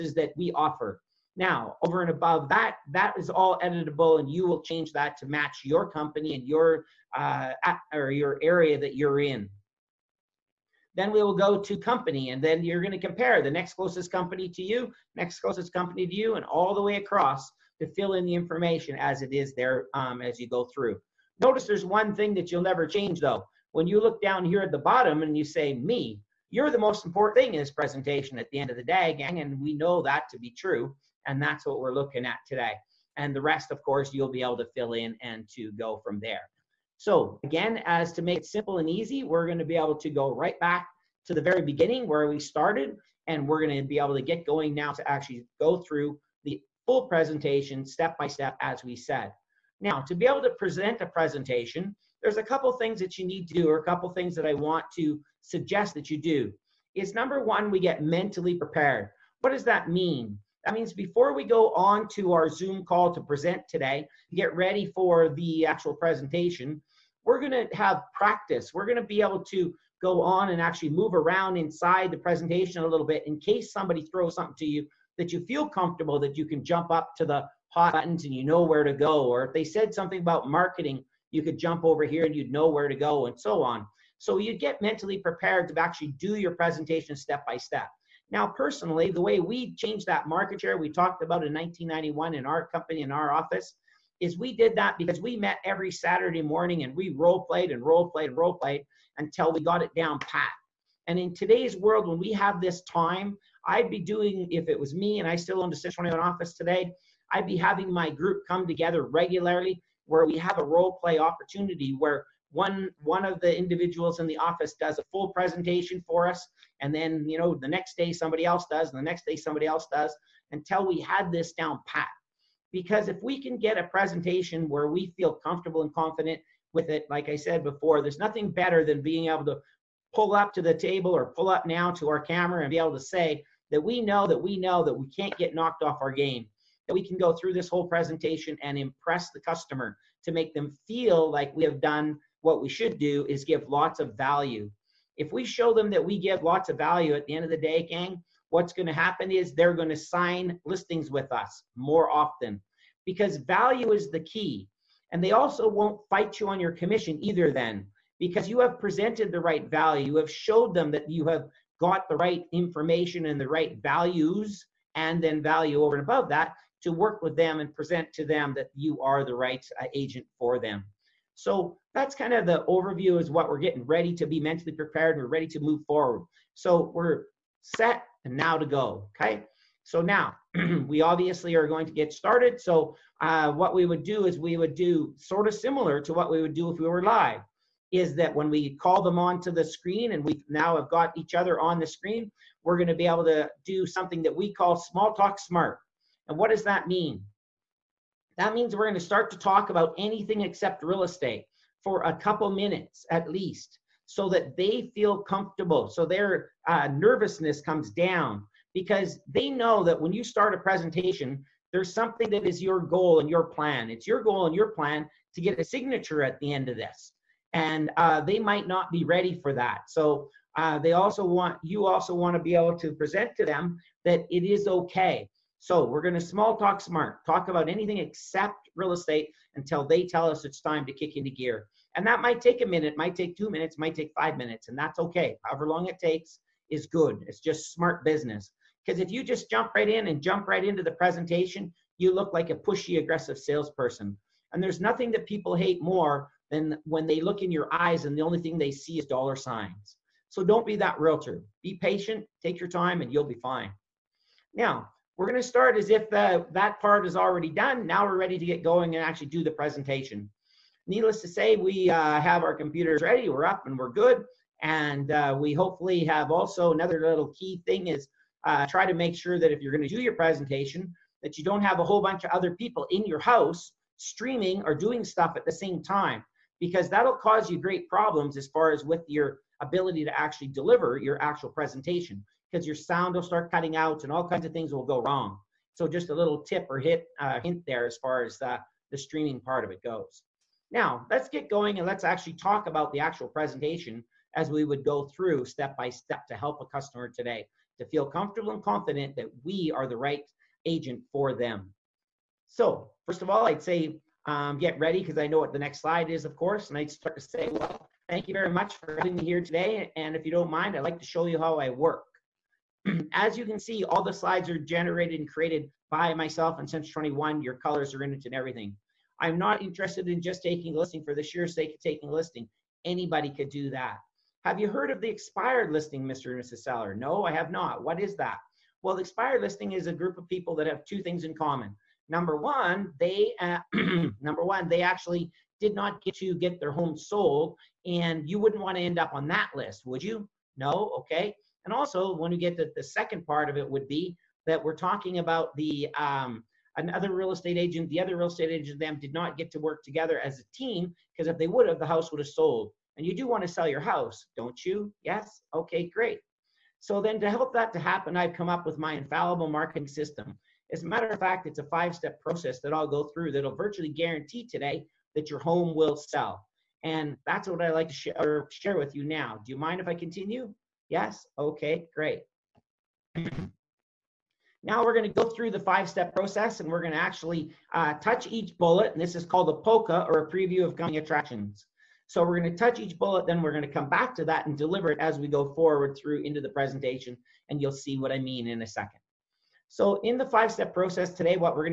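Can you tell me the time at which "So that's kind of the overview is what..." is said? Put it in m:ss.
2:51.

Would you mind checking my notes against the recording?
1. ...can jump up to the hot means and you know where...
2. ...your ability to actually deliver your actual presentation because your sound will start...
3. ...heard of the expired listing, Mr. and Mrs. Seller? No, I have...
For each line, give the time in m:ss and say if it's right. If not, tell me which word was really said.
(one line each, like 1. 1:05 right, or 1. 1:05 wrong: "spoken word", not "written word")
1. 1:16 wrong: "buttons", not "means"
2. 4:39 right
3. 5:24 right.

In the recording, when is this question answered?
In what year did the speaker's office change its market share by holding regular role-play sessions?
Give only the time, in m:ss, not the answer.
1:31.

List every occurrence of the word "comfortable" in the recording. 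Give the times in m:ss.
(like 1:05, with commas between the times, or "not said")
1:15, 2:05, 3:25, 4:58.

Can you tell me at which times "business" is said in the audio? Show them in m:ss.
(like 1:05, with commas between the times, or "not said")
3:58.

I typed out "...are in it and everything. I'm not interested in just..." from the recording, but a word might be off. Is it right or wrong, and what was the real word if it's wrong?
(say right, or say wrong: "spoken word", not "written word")
right.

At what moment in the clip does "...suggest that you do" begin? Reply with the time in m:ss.
0:55.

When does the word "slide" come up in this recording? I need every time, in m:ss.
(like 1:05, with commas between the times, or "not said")
5:05, 5:14.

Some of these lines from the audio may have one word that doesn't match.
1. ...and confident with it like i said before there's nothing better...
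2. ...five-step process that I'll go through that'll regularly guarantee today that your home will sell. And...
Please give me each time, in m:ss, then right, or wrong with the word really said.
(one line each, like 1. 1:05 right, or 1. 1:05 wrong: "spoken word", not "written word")
1. 2:05 right
2. 6:01 wrong: "virtually", not "regularly".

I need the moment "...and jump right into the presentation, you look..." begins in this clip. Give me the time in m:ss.
4:00.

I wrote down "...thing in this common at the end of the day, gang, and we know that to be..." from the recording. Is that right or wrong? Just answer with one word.
wrong.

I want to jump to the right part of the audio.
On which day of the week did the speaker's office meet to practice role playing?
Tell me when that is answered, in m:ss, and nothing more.
1:35.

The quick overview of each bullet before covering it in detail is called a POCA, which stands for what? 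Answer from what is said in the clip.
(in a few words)
preview of coming attractions.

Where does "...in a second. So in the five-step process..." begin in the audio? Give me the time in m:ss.
6:28.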